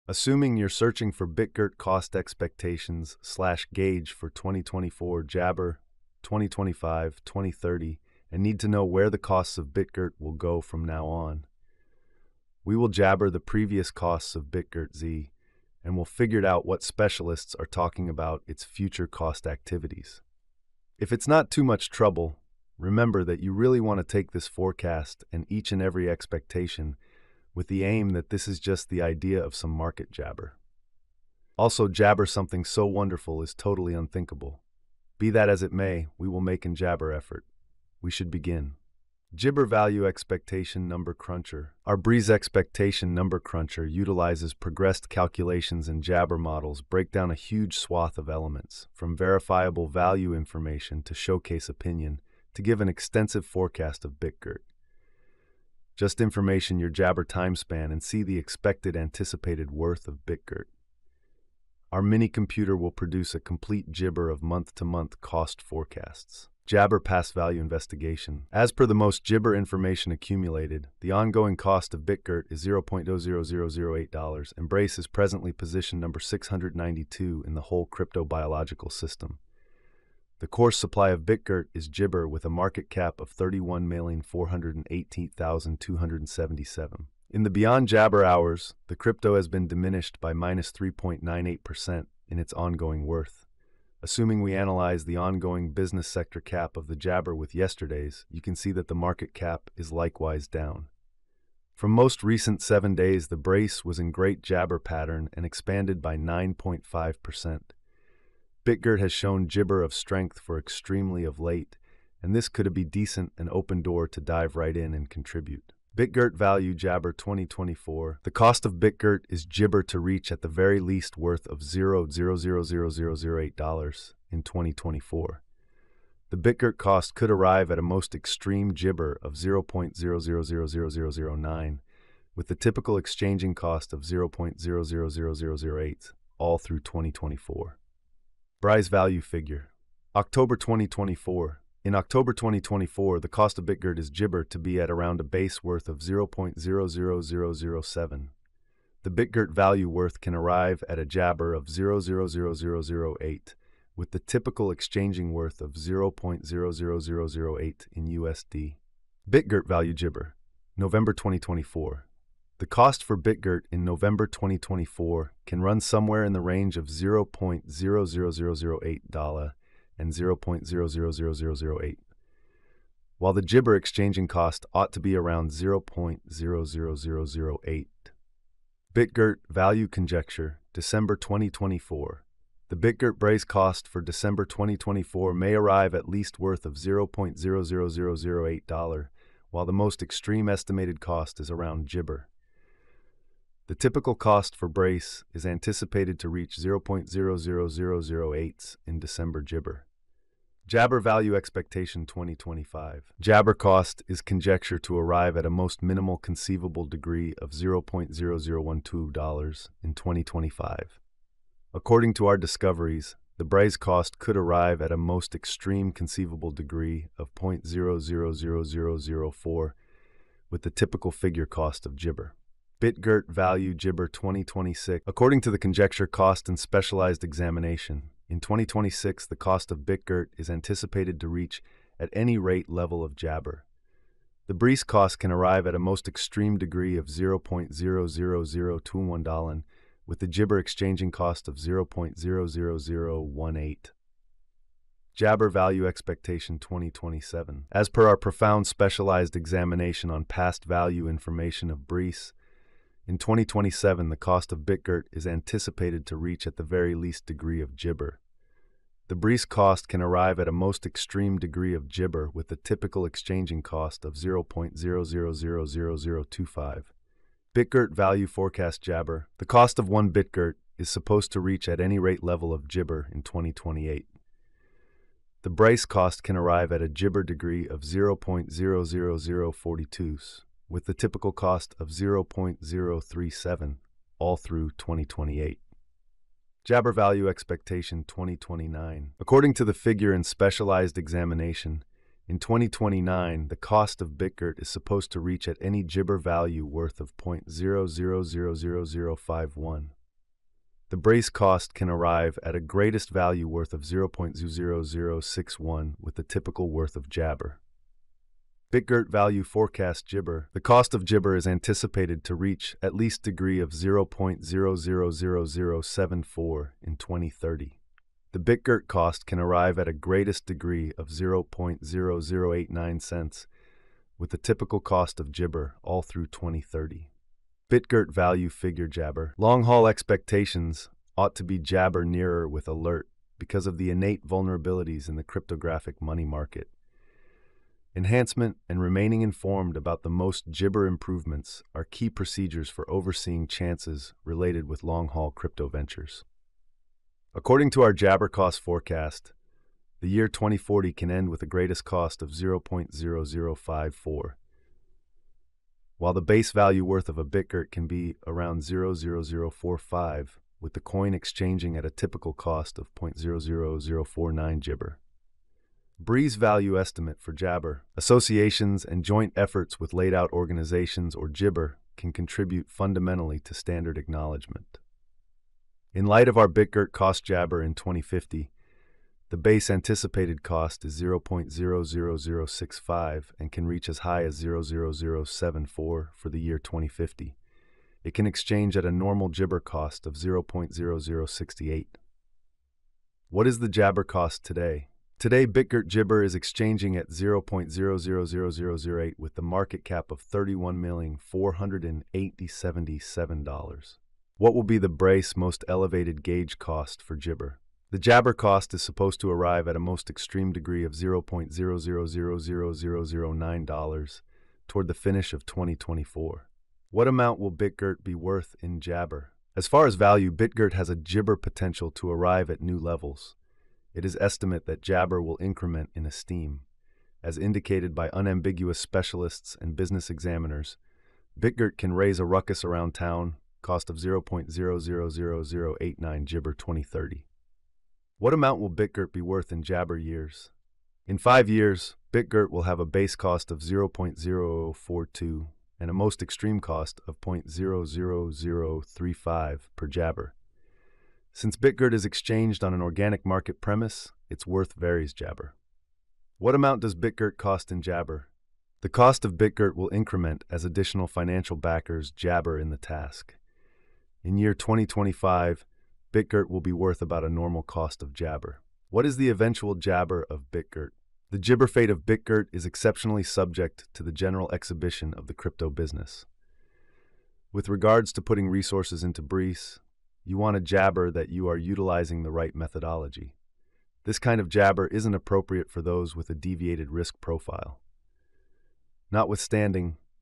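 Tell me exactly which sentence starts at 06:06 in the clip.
Bree's value estimate for Jabber, associations, and joint efforts with laid out organizations or Jibber can contribute fundamentally to standard acknowledgement.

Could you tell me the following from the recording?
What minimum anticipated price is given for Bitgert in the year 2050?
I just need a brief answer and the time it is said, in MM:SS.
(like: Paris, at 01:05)
0.00065, at 06:20.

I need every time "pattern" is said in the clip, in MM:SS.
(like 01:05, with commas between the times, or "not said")
01:44.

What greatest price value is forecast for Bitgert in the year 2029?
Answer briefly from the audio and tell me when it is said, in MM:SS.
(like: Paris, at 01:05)
0.00061, at 05:03.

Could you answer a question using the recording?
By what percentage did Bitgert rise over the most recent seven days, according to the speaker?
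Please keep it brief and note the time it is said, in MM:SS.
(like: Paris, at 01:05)
9.5%, at 01:46.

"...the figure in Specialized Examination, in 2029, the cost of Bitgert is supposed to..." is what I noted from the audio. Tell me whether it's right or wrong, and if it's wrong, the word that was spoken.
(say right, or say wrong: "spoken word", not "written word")
right.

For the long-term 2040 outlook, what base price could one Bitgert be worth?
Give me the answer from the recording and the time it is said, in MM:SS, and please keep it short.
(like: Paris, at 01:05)
0.00045, at 05:58.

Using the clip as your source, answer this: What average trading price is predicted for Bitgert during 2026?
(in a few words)
0.00018.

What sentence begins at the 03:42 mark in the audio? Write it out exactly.
BitGert Value jibber 2026, according to the Conjecture Cost and Specialized Examination.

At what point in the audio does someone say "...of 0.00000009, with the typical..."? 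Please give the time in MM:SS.
02:09.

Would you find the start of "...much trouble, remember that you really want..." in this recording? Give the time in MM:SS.
00:21.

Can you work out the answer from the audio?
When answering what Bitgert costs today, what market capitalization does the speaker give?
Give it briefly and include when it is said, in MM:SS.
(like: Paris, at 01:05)
$31,487,077, at 06:40.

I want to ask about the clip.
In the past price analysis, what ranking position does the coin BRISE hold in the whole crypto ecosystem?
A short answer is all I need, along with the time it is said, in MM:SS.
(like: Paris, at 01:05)
692, at 01:16.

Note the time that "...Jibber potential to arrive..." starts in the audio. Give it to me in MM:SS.
07:00.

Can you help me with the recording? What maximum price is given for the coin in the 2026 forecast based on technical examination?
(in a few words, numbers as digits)
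$0.00021.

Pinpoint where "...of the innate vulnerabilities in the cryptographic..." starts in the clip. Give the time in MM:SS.
05:33.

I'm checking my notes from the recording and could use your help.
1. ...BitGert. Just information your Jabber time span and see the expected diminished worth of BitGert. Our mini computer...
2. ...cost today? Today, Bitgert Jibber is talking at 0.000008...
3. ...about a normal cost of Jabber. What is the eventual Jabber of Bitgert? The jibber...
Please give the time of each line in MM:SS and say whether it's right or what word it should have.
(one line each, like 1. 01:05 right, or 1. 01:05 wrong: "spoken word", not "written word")
1. 00:54 wrong: "anticipated", not "diminished"
2. 06:34 wrong: "exchanging", not "talking"
3. 07:47 right.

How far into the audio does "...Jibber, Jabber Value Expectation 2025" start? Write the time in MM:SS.
03:19.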